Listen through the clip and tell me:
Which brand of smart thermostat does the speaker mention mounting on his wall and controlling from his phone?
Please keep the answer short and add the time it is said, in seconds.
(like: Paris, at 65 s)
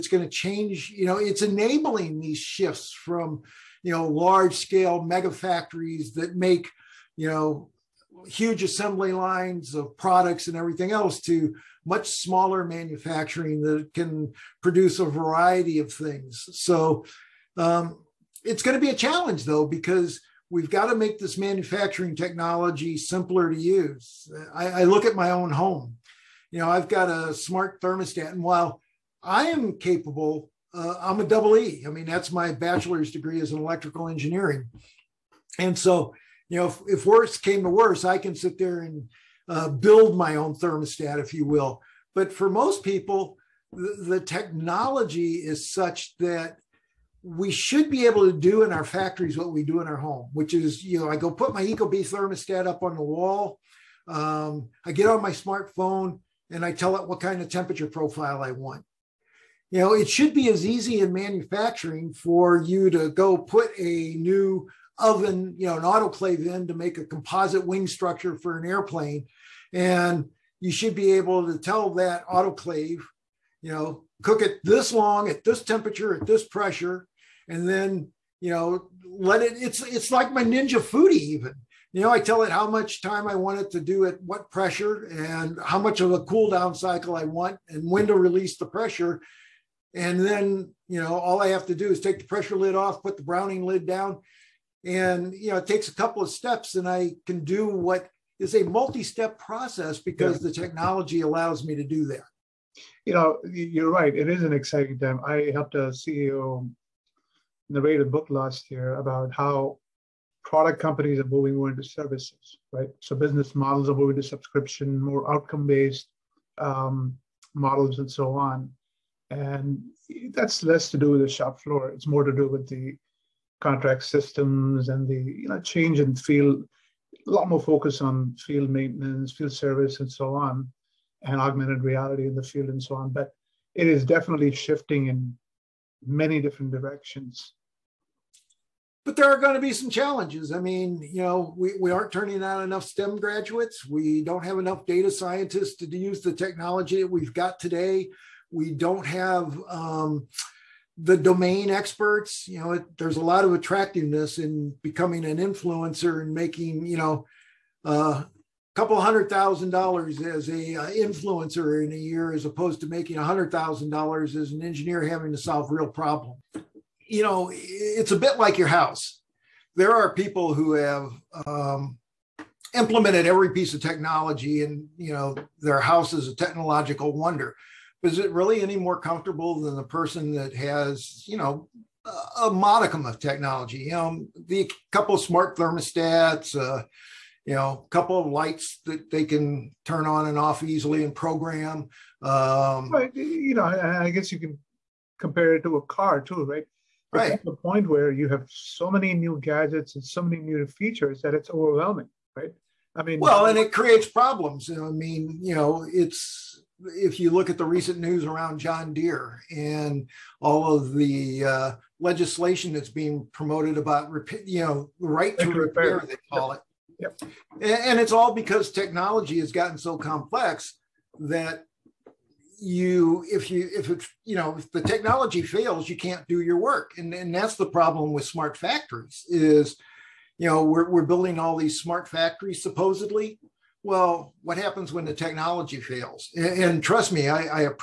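Ecobee, at 51 s.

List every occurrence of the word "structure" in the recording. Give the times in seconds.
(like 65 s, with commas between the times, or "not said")
67 s.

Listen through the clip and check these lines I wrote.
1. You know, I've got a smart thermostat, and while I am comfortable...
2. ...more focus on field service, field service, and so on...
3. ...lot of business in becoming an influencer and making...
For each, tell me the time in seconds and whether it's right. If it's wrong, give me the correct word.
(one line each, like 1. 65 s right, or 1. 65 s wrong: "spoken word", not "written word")
1. 26 s wrong: "capable", not "comfortable"
2. 127 s wrong: "maintenance", not "service"
3. 153 s wrong: "attractiveness", not "business".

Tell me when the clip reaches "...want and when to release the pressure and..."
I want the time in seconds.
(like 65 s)
87 s.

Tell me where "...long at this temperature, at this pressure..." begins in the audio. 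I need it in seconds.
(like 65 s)
74 s.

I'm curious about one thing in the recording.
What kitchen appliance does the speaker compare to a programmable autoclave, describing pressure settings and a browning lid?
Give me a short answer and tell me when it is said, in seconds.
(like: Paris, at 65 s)
Ninja Foodi, at 80 s.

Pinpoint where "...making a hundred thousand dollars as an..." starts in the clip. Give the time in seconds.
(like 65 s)
162 s.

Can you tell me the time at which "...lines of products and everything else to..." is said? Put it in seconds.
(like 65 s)
9 s.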